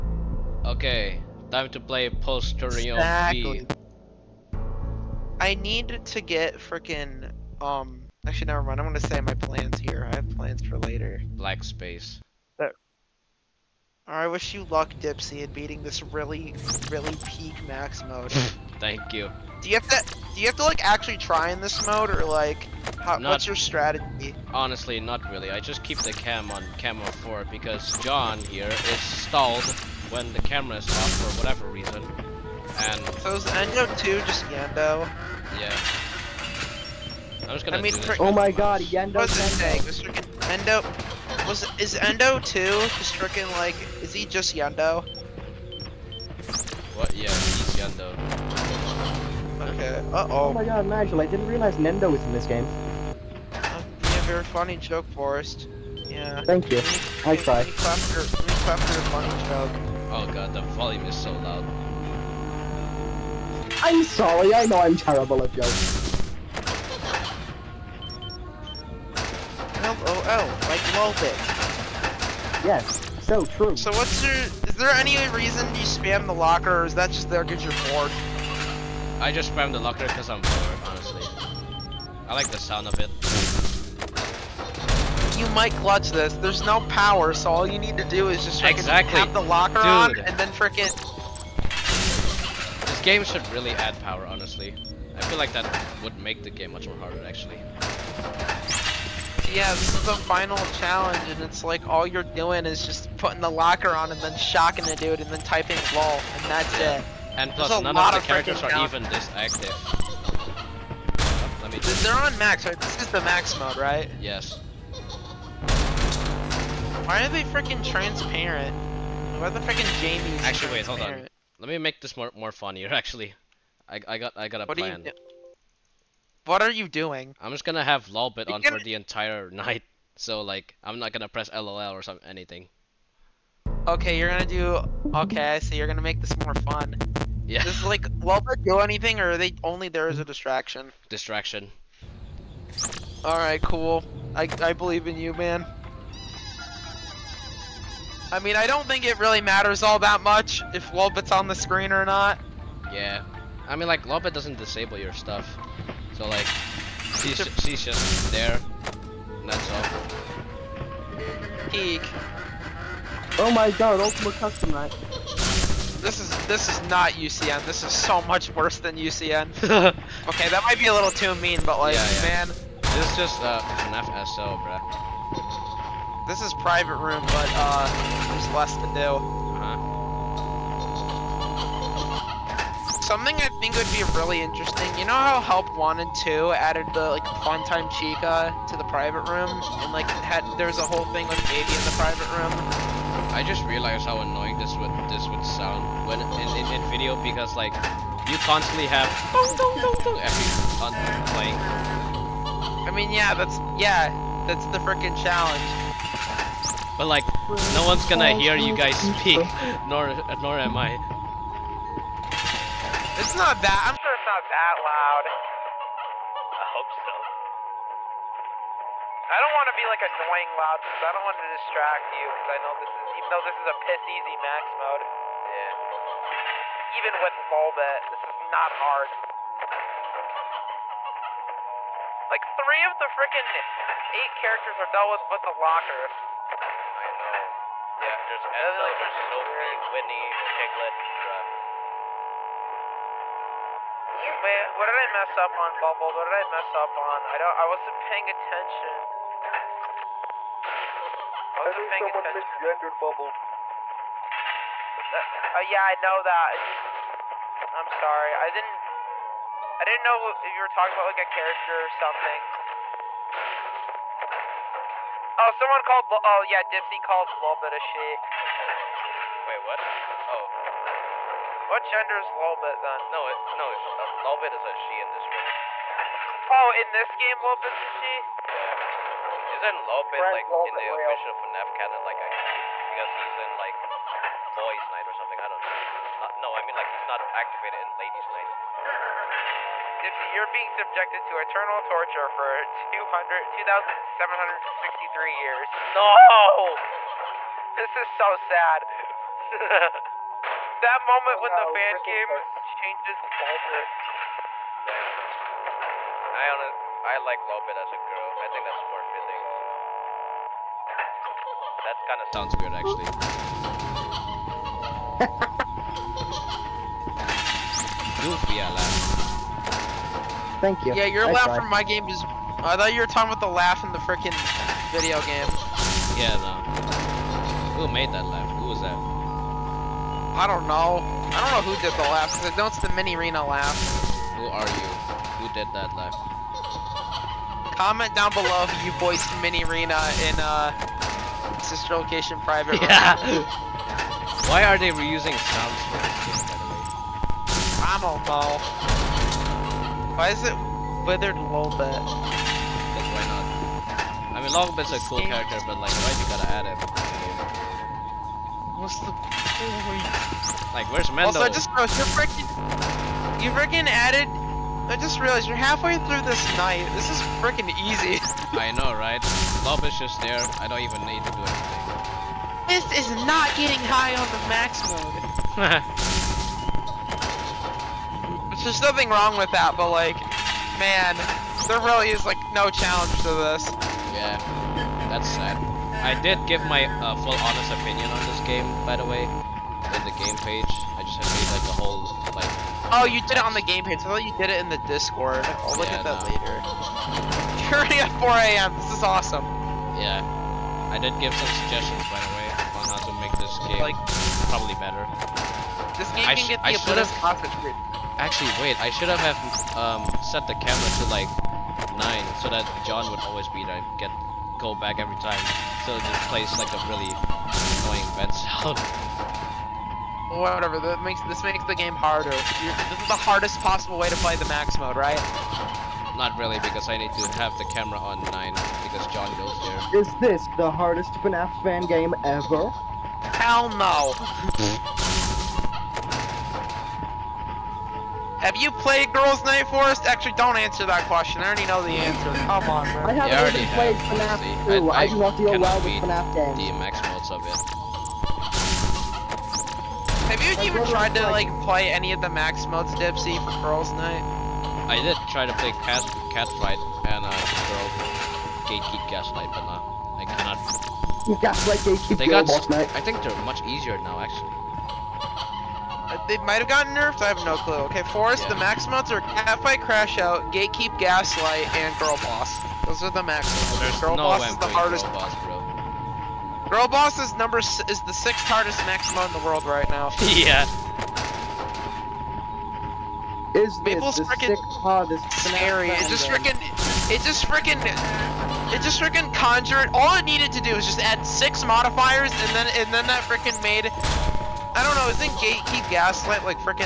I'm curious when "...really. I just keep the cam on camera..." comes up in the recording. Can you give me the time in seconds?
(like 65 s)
25 s.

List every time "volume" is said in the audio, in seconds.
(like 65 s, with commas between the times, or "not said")
60 s.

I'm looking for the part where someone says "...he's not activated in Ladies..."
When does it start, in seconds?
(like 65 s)
286 s.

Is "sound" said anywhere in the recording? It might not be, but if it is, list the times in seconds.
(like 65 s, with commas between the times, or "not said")
82 s, 195 s, 312 s, 345 s, 418 s.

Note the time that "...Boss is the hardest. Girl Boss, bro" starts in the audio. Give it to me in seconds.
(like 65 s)
474 s.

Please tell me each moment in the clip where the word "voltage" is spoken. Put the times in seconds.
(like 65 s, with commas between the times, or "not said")
not said.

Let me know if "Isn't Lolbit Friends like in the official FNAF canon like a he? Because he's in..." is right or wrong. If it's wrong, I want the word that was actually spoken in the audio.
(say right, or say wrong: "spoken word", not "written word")
right.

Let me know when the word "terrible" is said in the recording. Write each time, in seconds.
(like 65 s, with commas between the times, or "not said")
64 s.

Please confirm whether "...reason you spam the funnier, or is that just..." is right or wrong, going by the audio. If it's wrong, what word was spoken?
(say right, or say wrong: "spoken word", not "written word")
wrong: "locker", not "funnier".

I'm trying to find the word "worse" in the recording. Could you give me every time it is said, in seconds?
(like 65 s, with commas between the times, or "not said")
168 s.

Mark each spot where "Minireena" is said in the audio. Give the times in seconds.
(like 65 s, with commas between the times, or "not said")
332 s, 339 s.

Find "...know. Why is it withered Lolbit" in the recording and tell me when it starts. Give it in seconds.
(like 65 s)
348 s.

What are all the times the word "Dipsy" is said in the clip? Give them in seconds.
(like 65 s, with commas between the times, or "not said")
14 s, 266 s, 452 s.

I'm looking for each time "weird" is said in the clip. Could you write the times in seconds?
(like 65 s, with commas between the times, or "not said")
312 s.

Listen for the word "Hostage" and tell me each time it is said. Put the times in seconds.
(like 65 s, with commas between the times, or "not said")
407 s.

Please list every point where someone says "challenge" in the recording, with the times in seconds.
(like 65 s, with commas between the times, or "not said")
100 s, 205 s, 382 s.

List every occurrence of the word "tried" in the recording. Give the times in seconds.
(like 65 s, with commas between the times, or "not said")
57 s, 321 s, 450 s.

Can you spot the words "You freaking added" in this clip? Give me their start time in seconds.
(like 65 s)
363 s.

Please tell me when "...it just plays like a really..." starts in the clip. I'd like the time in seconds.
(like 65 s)
415 s.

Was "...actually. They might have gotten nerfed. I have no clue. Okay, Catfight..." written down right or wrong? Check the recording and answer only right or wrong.
wrong.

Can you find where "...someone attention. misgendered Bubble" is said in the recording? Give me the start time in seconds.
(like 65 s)
251 s.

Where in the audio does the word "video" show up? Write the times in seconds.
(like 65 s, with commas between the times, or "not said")
196 s, 324 s.